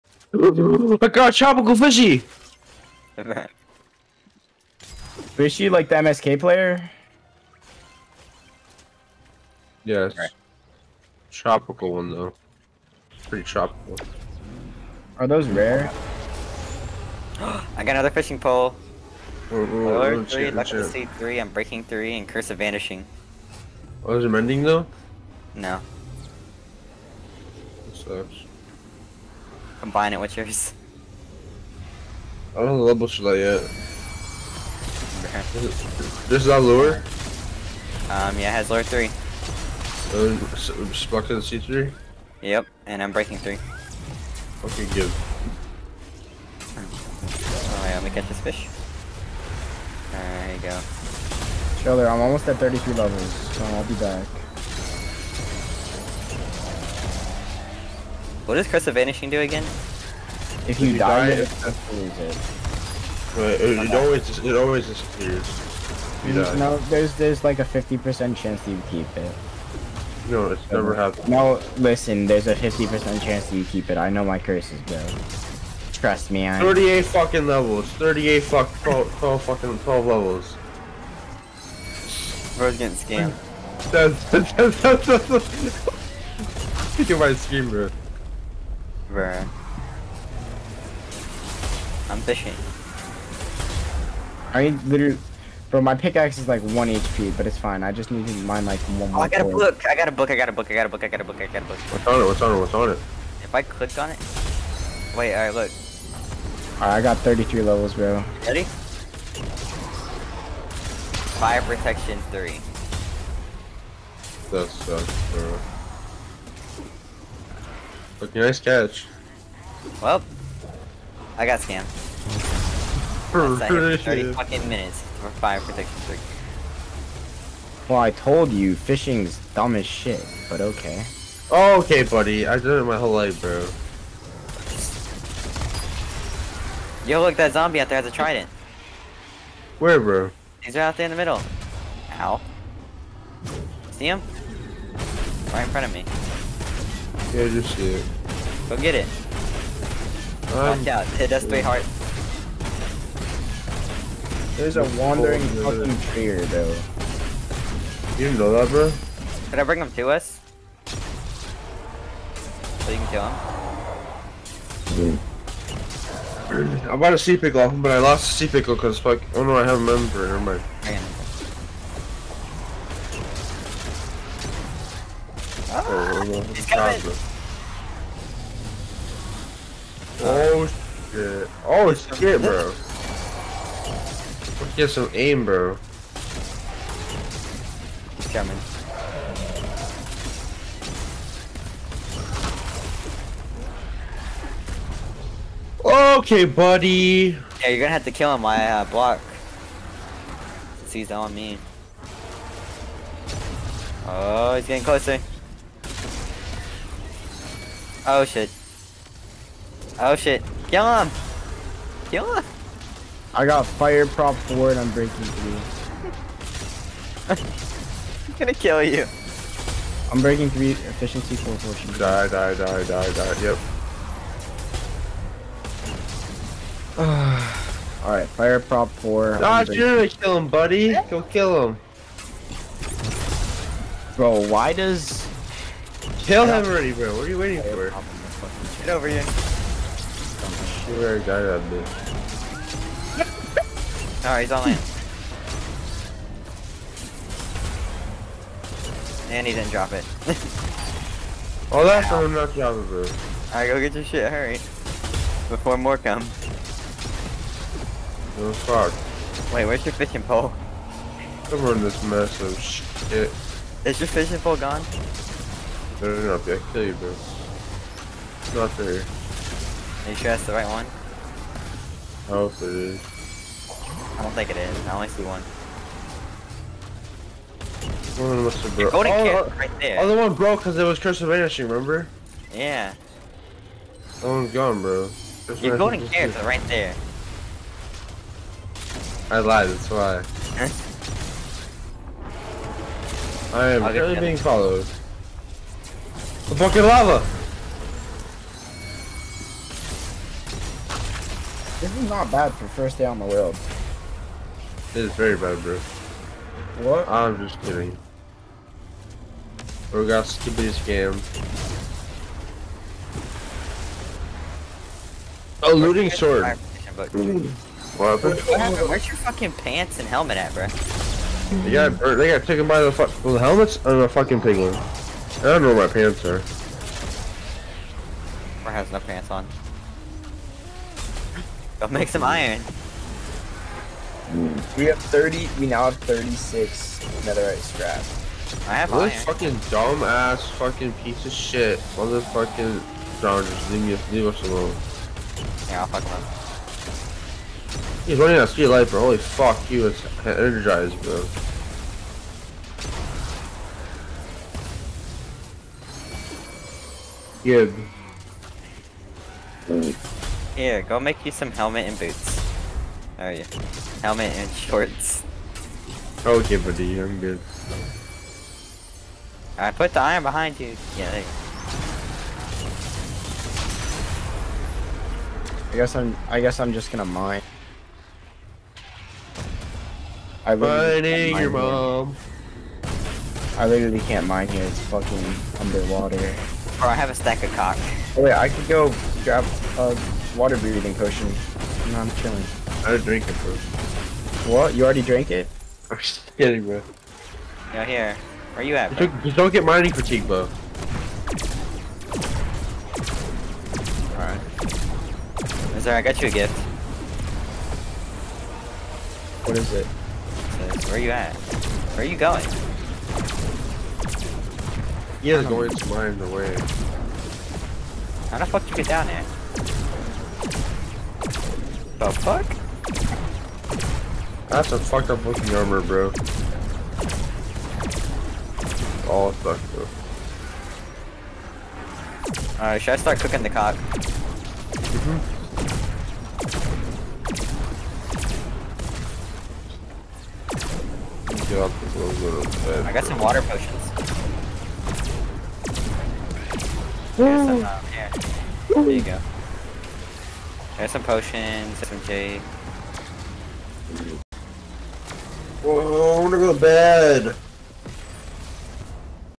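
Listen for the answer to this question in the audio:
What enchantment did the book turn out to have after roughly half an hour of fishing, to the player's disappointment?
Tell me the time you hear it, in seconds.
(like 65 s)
111 s.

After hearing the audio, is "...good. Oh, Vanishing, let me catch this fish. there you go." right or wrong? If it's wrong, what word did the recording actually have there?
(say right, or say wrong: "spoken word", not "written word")
wrong: "Alright", not "Vanishing".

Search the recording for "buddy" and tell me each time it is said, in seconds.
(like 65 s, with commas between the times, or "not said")
132 s, 196 s, 230 s, 366 s.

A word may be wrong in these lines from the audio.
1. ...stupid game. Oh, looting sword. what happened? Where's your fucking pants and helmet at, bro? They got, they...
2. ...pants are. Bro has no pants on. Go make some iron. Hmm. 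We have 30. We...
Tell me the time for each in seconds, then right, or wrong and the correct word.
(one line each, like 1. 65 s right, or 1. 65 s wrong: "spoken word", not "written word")
1. 310 s right
2. 325 s right.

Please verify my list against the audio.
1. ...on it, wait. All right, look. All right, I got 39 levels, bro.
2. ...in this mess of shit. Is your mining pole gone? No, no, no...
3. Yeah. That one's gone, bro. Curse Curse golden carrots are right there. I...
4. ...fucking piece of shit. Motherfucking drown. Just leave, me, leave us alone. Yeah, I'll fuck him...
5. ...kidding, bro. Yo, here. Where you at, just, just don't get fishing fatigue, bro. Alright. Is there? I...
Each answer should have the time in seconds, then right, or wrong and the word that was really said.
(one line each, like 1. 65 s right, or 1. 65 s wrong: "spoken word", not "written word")
1. 103 s wrong: "33", not "39"
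2. 261 s wrong: "fishing", not "mining"
3. 282 s wrong: "Your", not "Curse"
4. 340 s right
5. 396 s wrong: "mining", not "fishing".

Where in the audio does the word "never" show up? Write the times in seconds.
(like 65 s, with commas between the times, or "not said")
70 s, 170 s.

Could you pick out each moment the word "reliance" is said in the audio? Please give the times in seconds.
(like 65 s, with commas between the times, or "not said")
not said.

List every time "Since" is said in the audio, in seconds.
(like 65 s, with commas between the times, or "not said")
200 s.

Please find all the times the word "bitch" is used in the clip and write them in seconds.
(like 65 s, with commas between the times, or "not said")
241 s.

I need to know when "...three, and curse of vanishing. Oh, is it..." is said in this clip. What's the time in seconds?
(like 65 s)
21 s.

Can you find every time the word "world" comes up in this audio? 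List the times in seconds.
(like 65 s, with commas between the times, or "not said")
303 s.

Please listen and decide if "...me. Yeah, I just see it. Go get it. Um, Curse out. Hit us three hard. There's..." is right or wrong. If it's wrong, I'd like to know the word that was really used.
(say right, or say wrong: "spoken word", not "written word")
wrong: "Watch", not "Curse".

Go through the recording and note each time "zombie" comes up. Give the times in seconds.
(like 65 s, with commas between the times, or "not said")
137 s.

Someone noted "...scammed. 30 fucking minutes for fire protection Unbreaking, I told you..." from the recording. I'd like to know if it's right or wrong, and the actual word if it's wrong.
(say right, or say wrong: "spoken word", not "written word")
wrong: "Well", not "Unbreaking".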